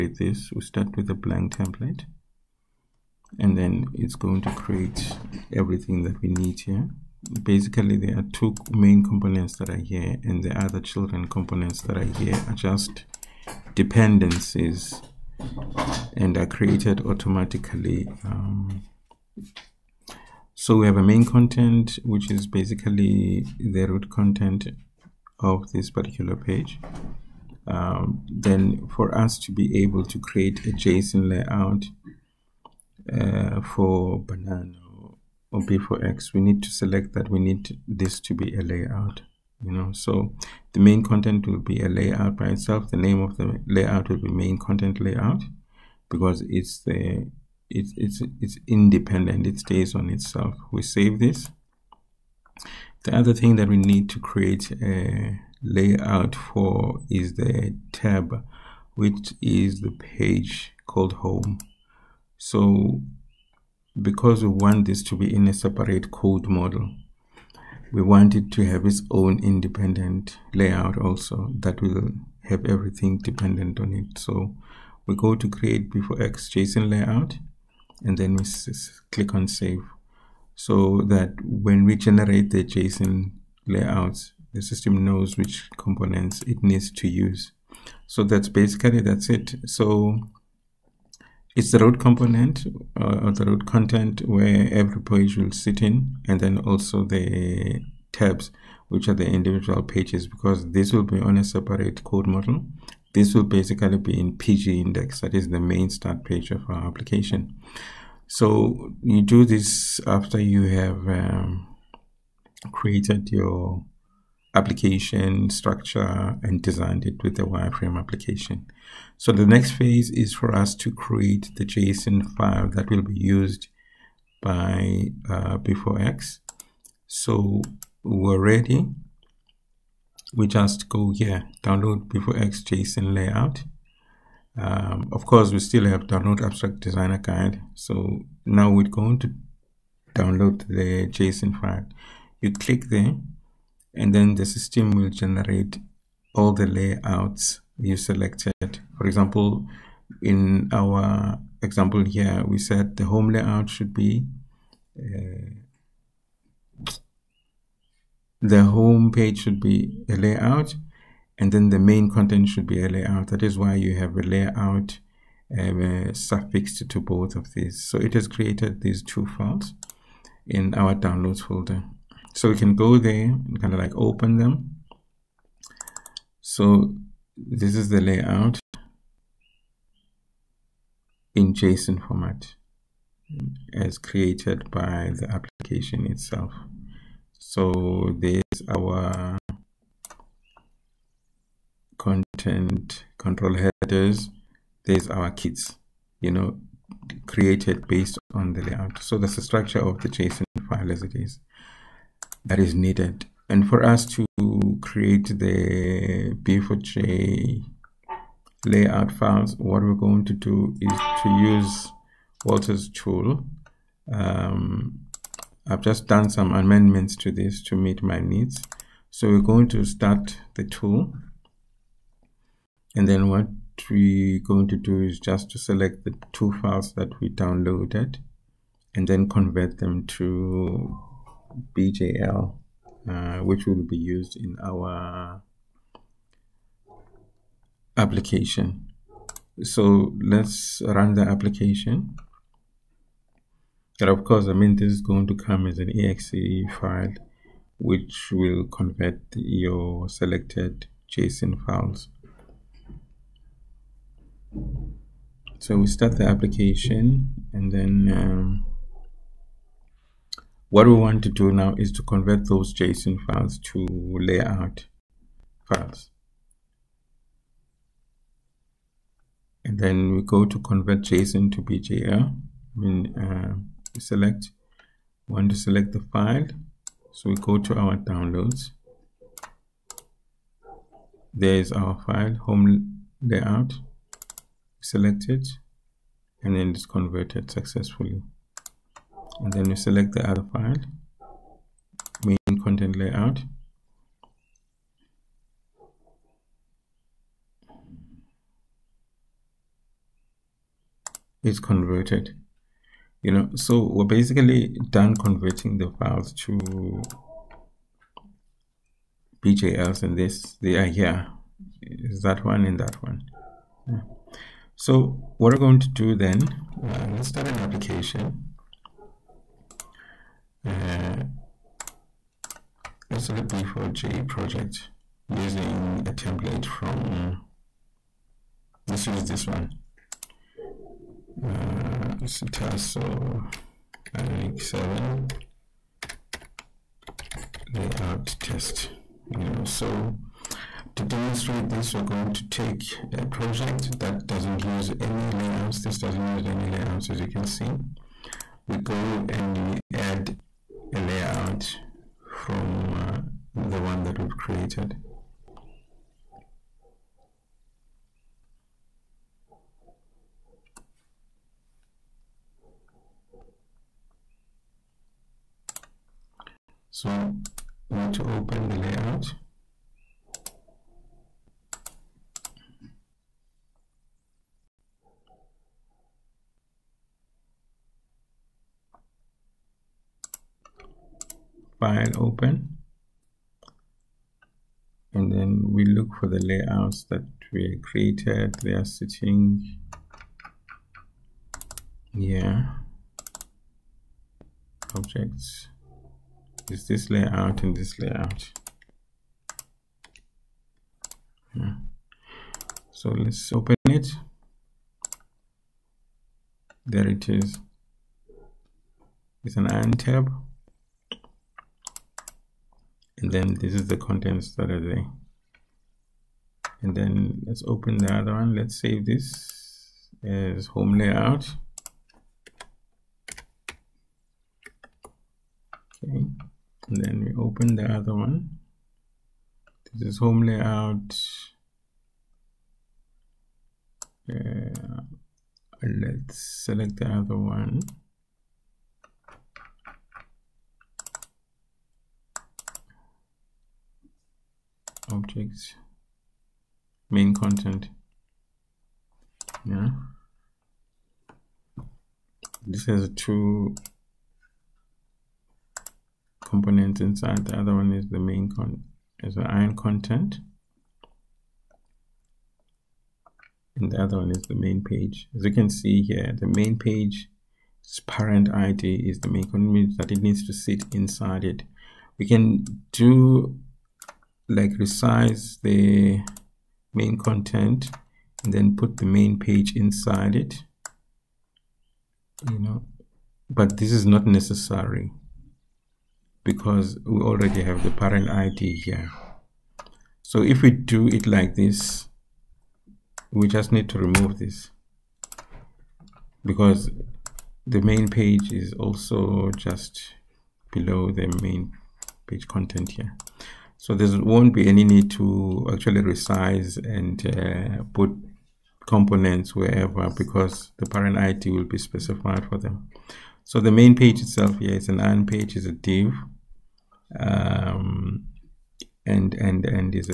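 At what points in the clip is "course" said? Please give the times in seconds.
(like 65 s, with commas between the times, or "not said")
135 s, 244 s.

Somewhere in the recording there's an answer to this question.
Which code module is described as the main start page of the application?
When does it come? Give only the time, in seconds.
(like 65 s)
104 s.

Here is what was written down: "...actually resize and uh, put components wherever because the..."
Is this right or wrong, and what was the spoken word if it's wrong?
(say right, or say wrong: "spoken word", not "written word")
right.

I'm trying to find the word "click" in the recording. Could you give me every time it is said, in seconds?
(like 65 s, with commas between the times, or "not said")
79 s, 142 s.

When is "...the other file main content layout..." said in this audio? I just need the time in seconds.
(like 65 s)
290 s.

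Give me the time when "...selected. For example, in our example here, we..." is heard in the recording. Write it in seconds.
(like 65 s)
147 s.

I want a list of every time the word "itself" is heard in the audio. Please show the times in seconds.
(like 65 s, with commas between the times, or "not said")
42 s, 50 s, 186 s, 514 s.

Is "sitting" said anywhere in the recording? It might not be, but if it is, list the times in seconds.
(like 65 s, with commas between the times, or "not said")
388 s.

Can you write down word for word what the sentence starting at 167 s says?
So it has created these two files in our downloads folder.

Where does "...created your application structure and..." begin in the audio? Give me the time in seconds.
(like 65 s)
112 s.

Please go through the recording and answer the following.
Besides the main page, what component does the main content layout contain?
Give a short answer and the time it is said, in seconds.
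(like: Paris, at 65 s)
ion content, at 459 s.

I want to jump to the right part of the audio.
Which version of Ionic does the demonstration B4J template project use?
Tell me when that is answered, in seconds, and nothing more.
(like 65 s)
334 s.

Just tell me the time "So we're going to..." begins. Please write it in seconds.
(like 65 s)
219 s.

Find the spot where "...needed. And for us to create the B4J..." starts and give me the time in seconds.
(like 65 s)
202 s.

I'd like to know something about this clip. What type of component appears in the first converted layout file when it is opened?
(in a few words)
ion tab.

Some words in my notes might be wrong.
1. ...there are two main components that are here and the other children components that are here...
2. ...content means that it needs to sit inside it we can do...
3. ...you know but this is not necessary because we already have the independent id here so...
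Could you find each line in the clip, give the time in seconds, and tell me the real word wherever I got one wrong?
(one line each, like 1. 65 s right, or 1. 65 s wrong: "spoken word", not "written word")
1. 7 s right
2. 469 s right
3. 482 s wrong: "parent", not "independent".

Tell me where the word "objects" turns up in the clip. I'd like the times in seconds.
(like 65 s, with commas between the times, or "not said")
394 s, 445 s.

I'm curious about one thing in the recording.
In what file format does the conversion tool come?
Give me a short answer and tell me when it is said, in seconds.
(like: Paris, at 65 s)
exe, at 245 s.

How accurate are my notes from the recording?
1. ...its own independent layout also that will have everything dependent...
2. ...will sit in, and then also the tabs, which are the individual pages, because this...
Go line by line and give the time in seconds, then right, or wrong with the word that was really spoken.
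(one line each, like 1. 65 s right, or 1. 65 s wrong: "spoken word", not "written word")
1. 68 s right
2. 95 s right.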